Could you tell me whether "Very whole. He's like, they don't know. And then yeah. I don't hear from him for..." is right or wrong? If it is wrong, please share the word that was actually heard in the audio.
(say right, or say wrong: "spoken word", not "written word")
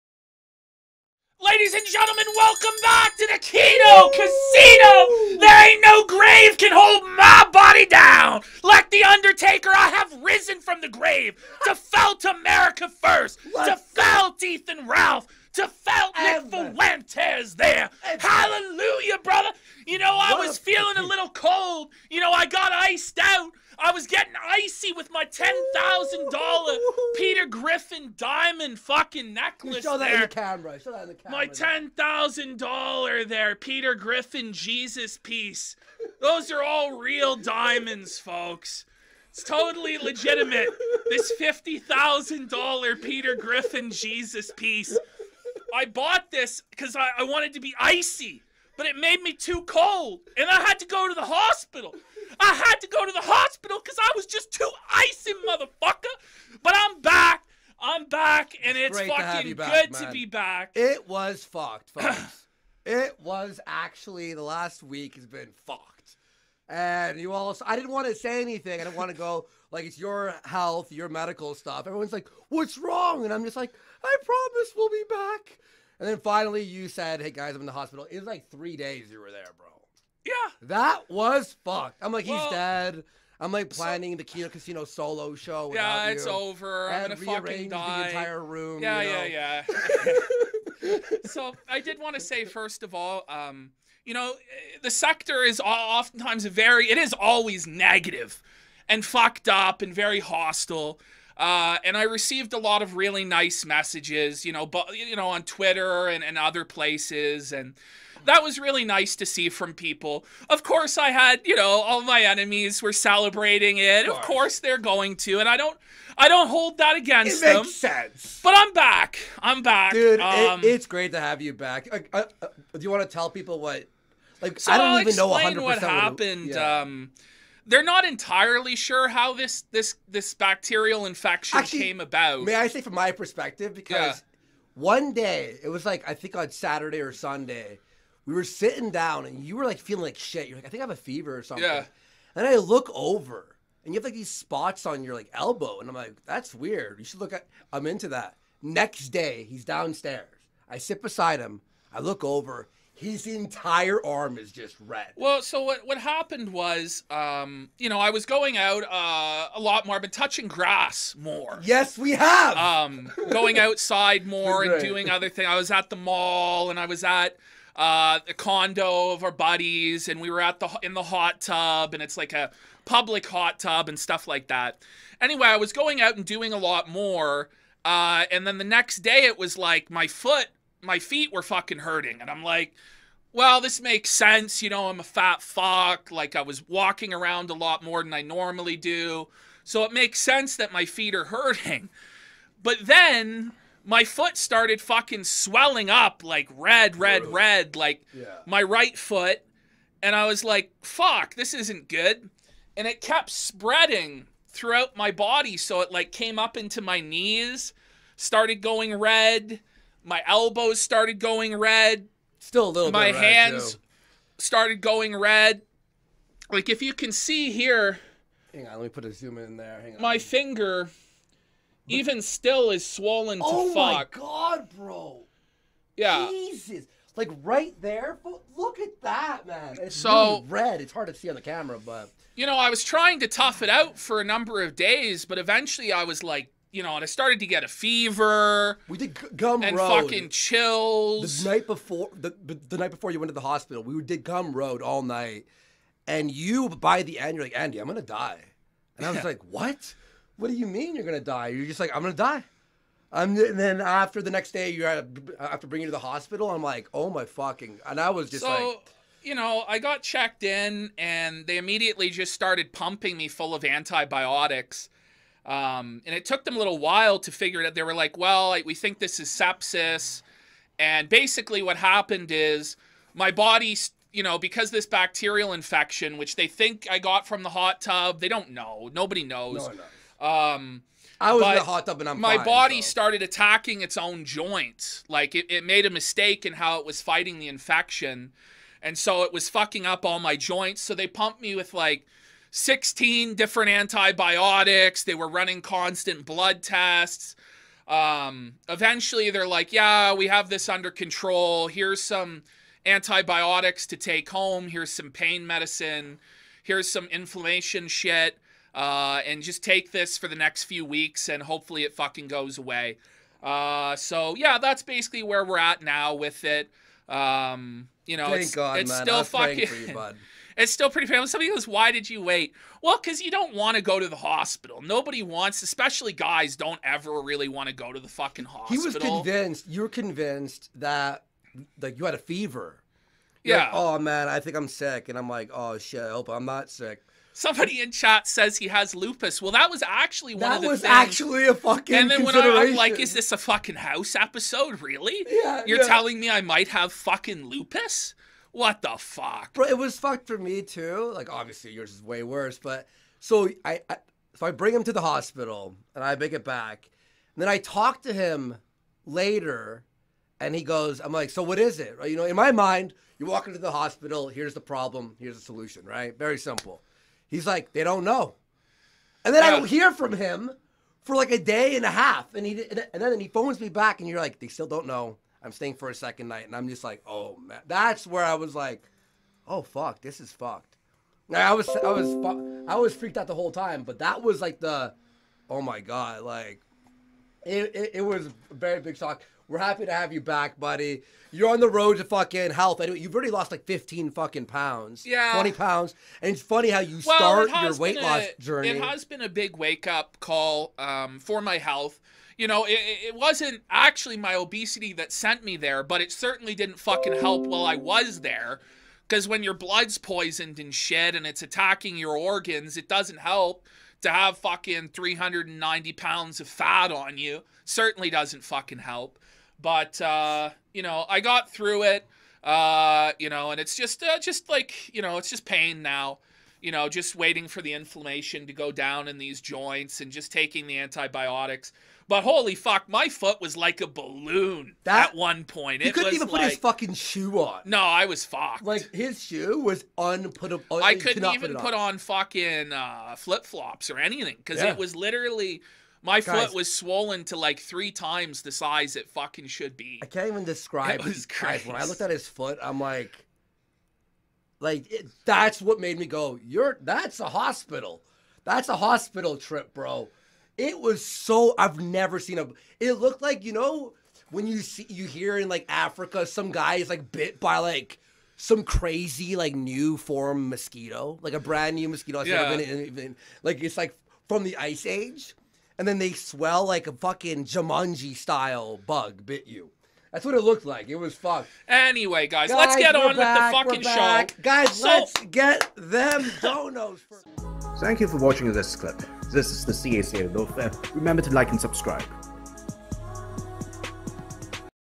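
wrong: "simple", not "whole".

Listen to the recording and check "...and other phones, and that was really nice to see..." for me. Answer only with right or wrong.
wrong.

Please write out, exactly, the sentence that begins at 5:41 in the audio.
And then when I, am like, "Is this a fucking house episode?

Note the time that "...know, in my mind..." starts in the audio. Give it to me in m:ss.
6:02.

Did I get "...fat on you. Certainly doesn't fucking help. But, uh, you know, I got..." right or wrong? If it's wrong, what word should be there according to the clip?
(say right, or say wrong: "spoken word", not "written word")
right.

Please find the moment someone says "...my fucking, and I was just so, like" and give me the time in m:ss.
4:17.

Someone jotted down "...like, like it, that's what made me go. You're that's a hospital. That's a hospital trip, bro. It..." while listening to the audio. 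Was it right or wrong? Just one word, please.
right.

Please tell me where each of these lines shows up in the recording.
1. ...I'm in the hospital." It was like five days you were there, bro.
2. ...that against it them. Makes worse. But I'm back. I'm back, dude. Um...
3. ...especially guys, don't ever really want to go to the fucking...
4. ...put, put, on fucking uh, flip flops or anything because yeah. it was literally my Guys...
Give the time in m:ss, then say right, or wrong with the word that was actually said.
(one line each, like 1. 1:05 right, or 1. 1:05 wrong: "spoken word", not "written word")
1. 1:17 wrong: "three", not "five"
2. 1:56 wrong: "sense", not "worse"
3. 5:25 right
4. 7:21 right.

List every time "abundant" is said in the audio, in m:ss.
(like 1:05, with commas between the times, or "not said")
not said.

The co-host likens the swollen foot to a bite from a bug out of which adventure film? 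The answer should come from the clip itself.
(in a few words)
Jumanji.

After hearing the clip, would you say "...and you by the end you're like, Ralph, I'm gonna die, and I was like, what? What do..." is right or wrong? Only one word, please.
wrong.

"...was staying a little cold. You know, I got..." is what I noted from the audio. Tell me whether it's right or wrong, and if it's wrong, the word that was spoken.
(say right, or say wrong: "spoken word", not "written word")
wrong: "feeling", not "staying".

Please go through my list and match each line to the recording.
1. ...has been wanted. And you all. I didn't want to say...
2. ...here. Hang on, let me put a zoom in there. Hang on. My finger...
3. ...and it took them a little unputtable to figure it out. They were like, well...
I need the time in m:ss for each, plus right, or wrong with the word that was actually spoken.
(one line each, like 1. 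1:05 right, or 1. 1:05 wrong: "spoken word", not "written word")
1. 1:05 wrong: "fucked", not "wanted"
2. 3:37 right
3. 4:26 wrong: "while", not "unputtable".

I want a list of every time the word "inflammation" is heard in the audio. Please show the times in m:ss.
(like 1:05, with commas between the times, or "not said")
5:07, 7:07.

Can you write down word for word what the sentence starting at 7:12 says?
But holy fuck, my foot was like a balloon that, at one point.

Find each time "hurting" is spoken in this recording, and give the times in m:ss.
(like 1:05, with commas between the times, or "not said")
3:01, 3:11.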